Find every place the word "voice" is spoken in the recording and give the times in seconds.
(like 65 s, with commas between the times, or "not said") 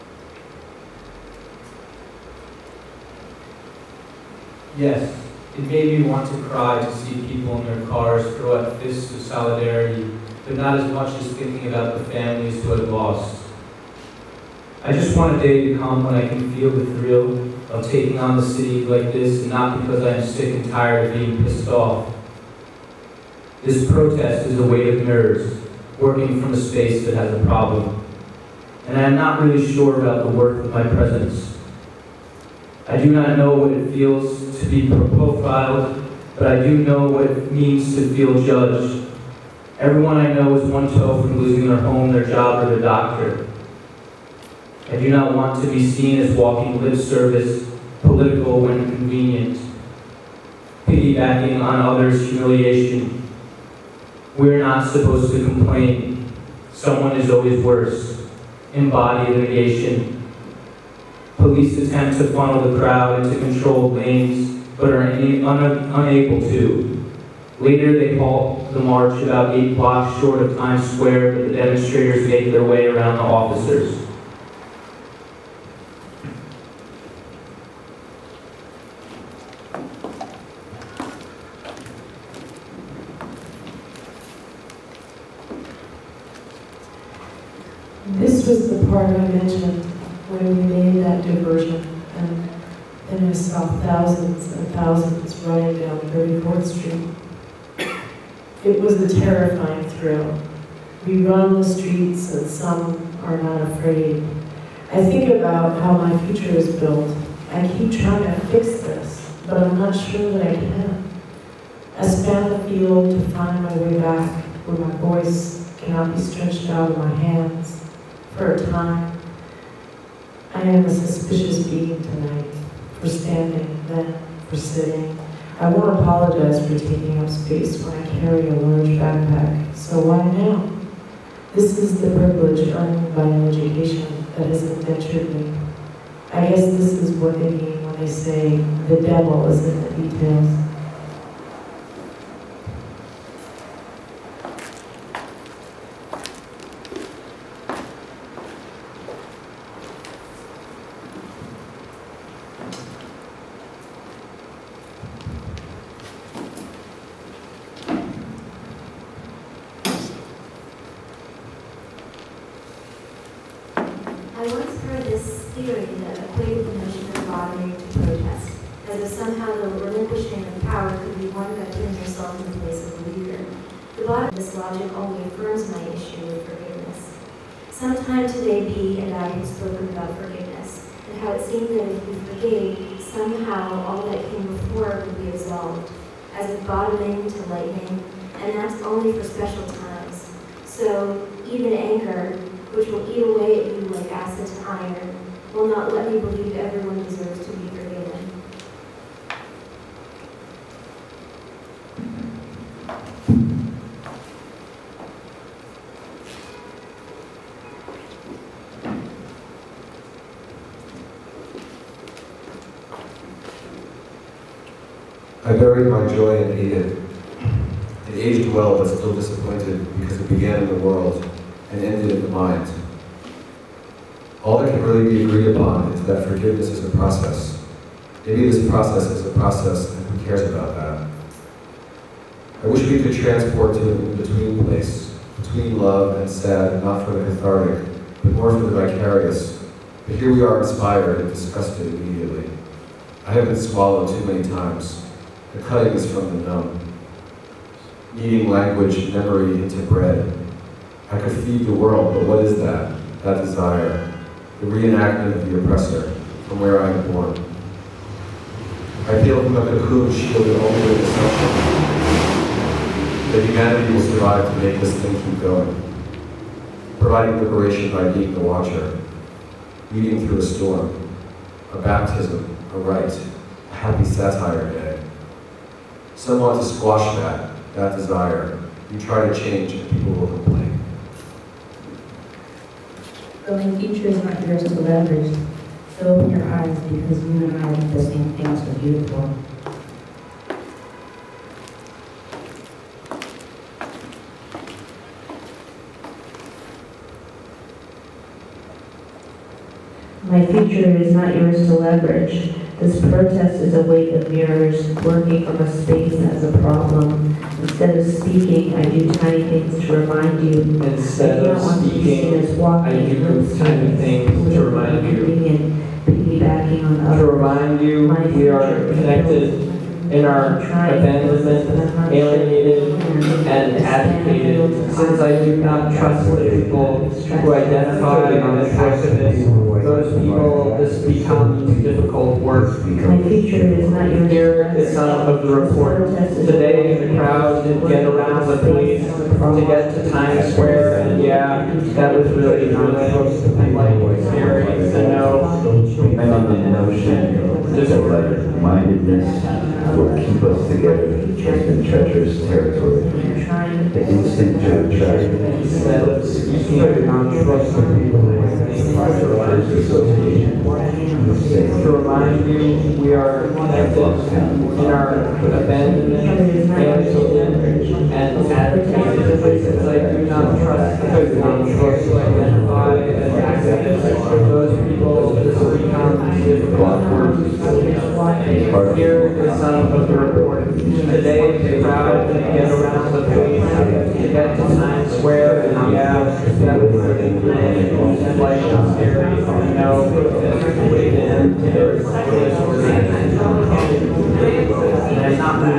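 114 s.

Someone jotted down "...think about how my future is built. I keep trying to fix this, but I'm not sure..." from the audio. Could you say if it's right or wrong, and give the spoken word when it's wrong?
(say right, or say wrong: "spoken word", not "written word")
right.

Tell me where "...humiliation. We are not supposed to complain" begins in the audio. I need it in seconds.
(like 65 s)
52 s.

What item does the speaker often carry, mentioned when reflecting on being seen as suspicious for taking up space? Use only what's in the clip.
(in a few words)
a large backpack.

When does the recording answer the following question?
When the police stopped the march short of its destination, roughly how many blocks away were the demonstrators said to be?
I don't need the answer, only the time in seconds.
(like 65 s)
69 s.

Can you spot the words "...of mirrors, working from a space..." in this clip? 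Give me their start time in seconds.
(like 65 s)
304 s.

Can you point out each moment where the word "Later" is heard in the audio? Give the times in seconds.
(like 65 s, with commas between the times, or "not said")
67 s.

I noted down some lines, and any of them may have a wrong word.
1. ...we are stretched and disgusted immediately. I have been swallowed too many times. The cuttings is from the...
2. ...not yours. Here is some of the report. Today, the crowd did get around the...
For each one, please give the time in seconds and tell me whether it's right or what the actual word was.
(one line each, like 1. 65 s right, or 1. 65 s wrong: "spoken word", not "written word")
1. 240 s wrong: "inspired", not "stretched"
2. 333 s right.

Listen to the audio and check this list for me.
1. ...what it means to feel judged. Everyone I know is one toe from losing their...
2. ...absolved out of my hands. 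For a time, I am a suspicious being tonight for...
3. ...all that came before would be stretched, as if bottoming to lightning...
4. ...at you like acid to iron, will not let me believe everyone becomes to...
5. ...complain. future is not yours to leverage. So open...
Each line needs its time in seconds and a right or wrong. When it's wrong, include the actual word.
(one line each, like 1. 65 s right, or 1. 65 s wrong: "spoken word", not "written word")
1. 37 s right
2. 116 s wrong: "stretched", not "absolved"
3. 183 s wrong: "absolved", not "stretched"
4. 193 s wrong: "deserves", not "becomes"
5. 280 s right.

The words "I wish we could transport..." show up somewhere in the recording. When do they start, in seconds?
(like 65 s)
232 s.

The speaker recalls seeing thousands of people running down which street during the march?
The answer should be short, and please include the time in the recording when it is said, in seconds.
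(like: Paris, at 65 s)
34th Street, at 96 s.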